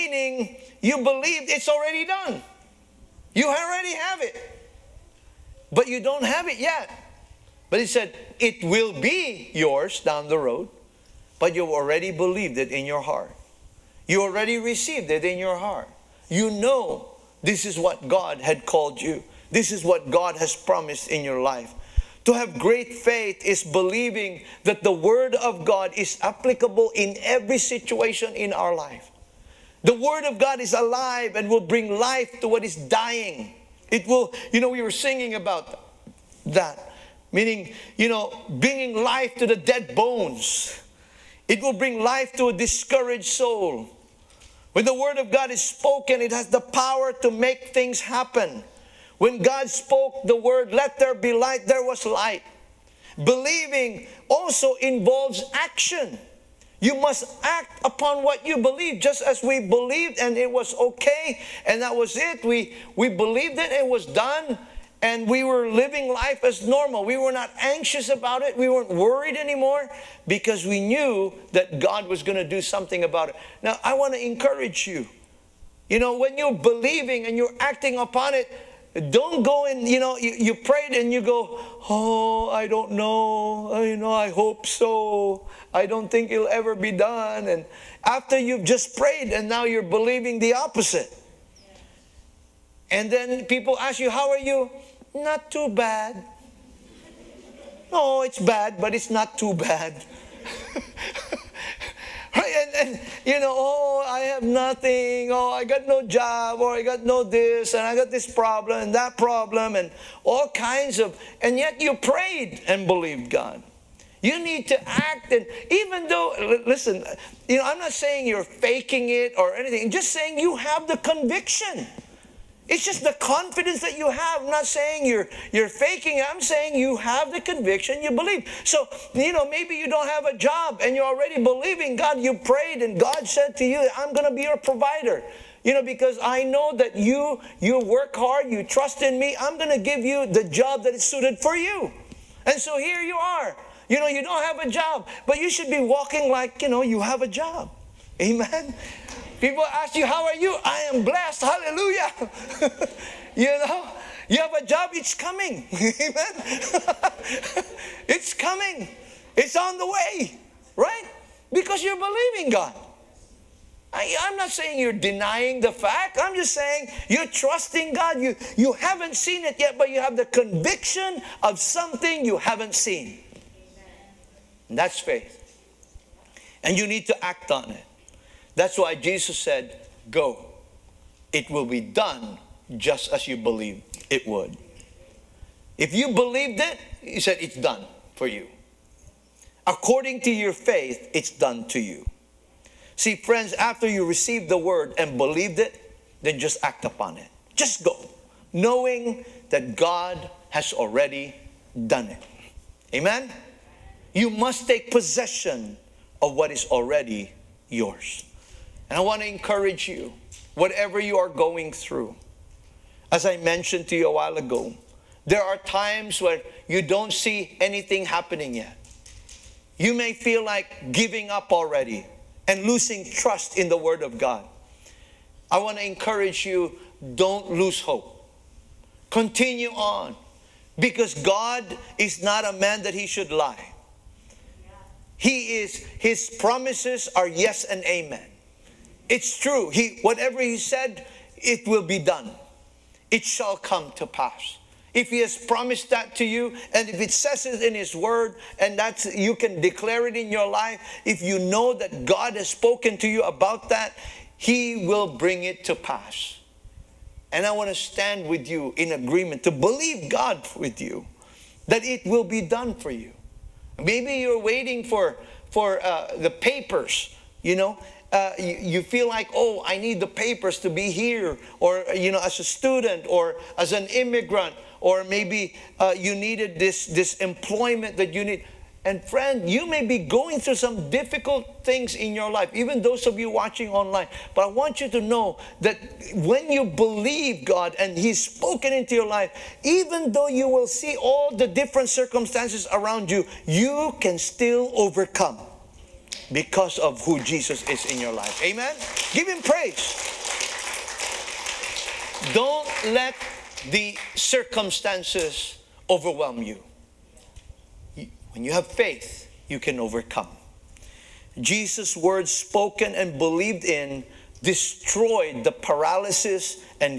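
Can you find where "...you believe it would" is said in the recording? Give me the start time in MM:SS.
03:03.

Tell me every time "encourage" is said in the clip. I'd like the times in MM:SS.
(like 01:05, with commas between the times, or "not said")
01:14, 03:29, 03:45.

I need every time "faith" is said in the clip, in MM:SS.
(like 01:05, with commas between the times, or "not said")
00:22, 02:54, 03:10, 05:08.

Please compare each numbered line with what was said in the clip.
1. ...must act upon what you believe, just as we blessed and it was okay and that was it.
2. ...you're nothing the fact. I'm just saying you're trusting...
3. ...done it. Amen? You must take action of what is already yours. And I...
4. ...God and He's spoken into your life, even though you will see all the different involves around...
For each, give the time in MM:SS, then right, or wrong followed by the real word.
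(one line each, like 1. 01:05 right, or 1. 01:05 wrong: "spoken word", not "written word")
1. 00:56 wrong: "believed", not "blessed"
2. 02:44 wrong: "denying", not "nothing"
3. 03:21 wrong: "possession", not "action"
4. 04:47 wrong: "circumstances", not "involves".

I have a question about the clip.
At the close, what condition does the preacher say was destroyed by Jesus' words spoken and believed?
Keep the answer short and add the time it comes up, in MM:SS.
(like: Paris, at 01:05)
Paralysis, at 05:15.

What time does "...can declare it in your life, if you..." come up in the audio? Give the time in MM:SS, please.
04:09.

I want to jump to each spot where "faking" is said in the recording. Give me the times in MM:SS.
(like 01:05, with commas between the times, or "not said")
01:58, 02:05.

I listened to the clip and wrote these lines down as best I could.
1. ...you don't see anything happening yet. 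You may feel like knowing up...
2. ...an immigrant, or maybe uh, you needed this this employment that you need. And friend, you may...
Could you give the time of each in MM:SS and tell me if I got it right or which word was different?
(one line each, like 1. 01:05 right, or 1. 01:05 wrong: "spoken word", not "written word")
1. 03:36 wrong: "giving", not "knowing"
2. 04:33 right.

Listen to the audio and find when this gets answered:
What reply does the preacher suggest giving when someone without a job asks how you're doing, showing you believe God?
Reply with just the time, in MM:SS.
02:30.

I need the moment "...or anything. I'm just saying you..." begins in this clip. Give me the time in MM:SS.
01:59.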